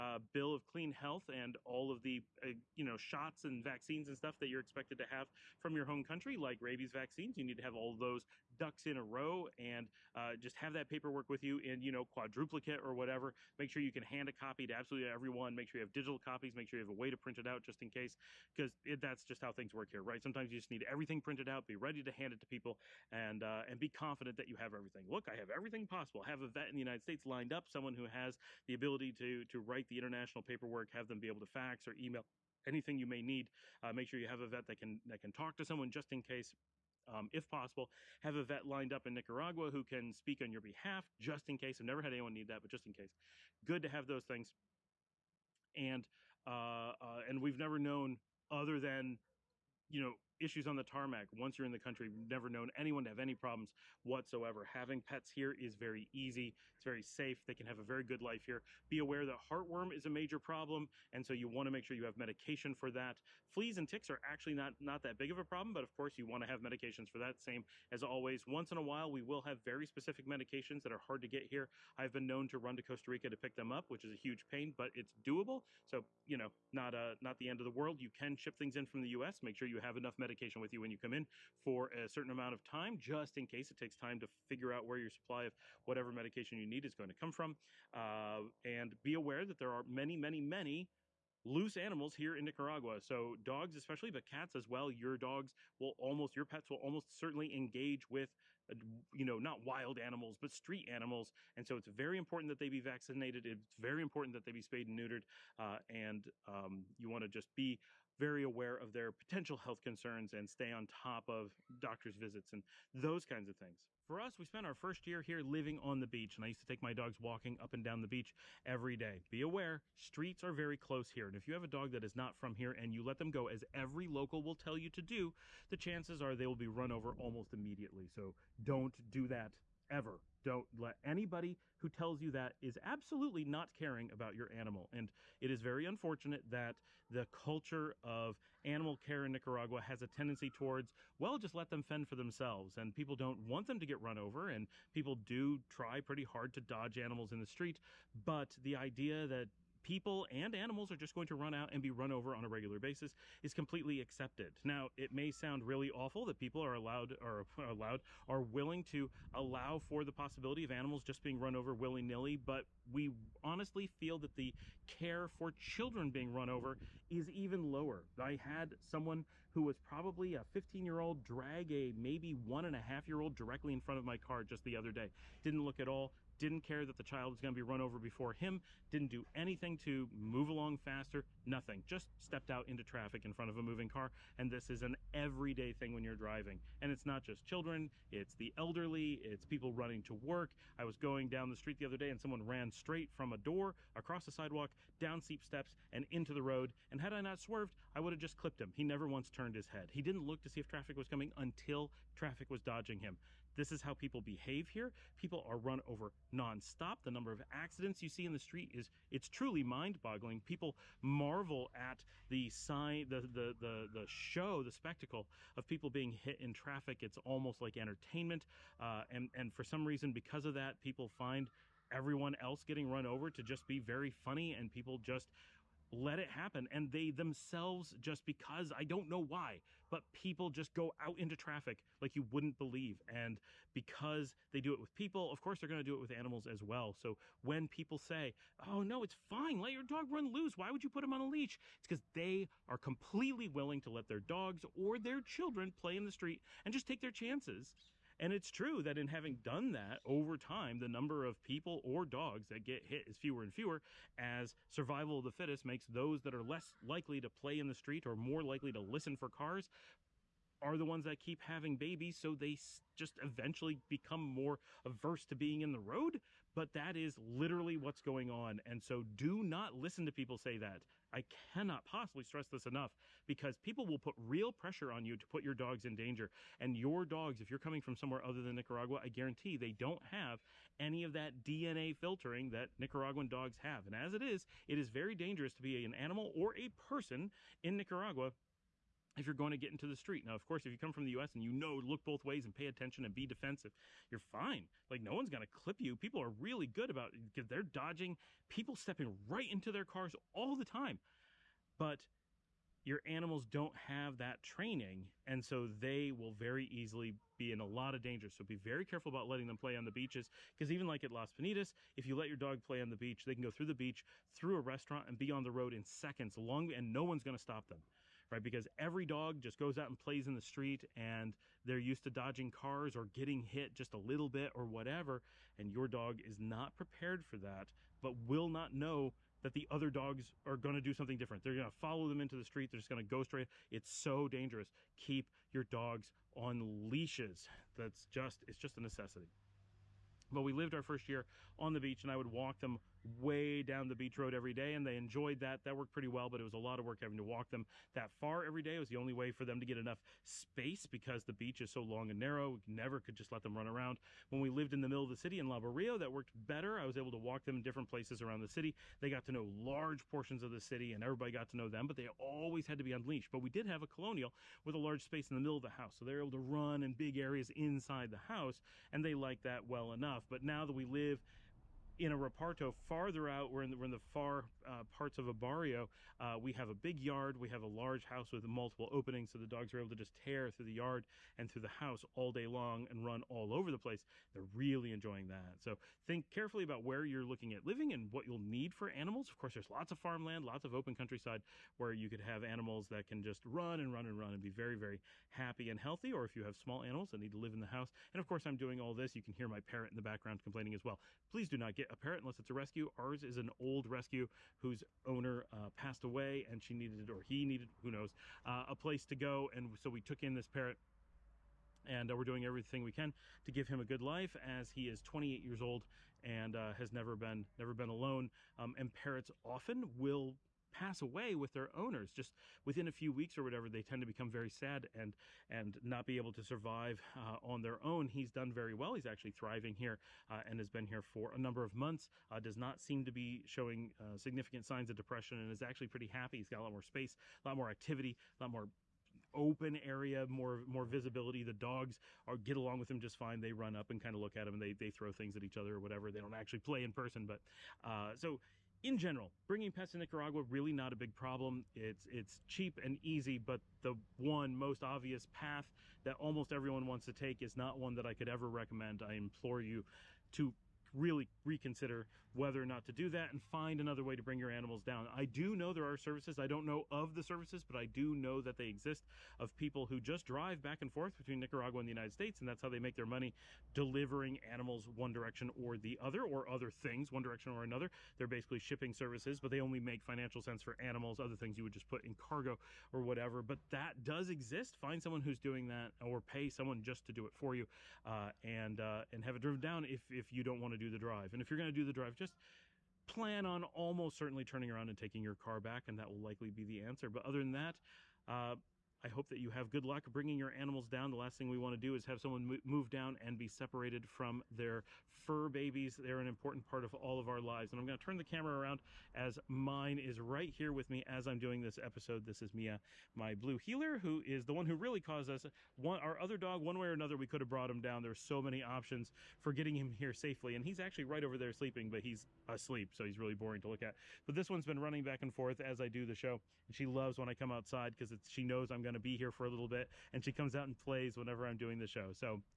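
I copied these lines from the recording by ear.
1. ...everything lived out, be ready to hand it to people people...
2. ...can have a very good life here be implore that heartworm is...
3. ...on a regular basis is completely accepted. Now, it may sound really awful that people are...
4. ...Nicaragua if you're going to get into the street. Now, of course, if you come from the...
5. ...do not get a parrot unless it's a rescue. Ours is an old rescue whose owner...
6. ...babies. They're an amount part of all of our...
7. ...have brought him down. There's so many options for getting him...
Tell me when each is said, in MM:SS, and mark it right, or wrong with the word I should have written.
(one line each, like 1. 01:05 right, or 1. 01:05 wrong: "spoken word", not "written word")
1. 00:20 wrong: "printed", not "lived"
2. 00:57 wrong: "aware", not "implore"
3. 02:32 right
4. 04:47 right
5. 06:41 right
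6. 08:25 wrong: "important", not "amount"
7. 08:37 right.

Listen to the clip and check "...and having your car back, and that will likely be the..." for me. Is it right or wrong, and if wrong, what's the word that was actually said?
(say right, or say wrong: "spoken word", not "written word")
wrong: "taking", not "having".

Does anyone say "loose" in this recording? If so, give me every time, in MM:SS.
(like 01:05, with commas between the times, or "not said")
01:31, 04:00.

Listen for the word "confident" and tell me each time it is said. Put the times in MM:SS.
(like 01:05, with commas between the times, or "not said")
00:23.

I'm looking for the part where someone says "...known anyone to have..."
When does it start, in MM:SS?
00:52.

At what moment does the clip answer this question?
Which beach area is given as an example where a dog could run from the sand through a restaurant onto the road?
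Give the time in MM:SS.
05:11.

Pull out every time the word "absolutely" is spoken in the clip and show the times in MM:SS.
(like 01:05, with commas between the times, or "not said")
00:14, 02:12.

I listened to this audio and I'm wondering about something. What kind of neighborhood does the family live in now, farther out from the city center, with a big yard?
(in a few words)
Reparto.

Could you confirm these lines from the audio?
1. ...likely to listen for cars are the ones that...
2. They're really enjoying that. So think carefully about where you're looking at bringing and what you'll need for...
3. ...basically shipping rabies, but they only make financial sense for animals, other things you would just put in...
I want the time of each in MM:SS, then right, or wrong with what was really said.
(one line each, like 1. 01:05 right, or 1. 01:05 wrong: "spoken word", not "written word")
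1. 04:18 right
2. 06:24 wrong: "living", not "bringing"
3. 07:58 wrong: "services", not "rabies".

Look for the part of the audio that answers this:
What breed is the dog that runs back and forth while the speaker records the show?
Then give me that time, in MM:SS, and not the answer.
08:33.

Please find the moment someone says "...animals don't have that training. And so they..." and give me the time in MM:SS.
05:03.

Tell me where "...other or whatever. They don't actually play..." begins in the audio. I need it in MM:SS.
07:25.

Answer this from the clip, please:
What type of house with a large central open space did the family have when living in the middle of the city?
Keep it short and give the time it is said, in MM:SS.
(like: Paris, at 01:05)
A colonial, at 06:03.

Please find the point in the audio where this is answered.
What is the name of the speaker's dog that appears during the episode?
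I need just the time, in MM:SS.
08:32.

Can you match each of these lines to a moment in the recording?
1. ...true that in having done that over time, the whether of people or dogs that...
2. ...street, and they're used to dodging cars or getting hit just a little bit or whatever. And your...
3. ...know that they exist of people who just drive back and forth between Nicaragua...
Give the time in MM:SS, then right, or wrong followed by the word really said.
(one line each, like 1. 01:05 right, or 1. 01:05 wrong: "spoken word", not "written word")
1. 04:08 wrong: "number", not "whether"
2. 05:20 right
3. 07:48 right.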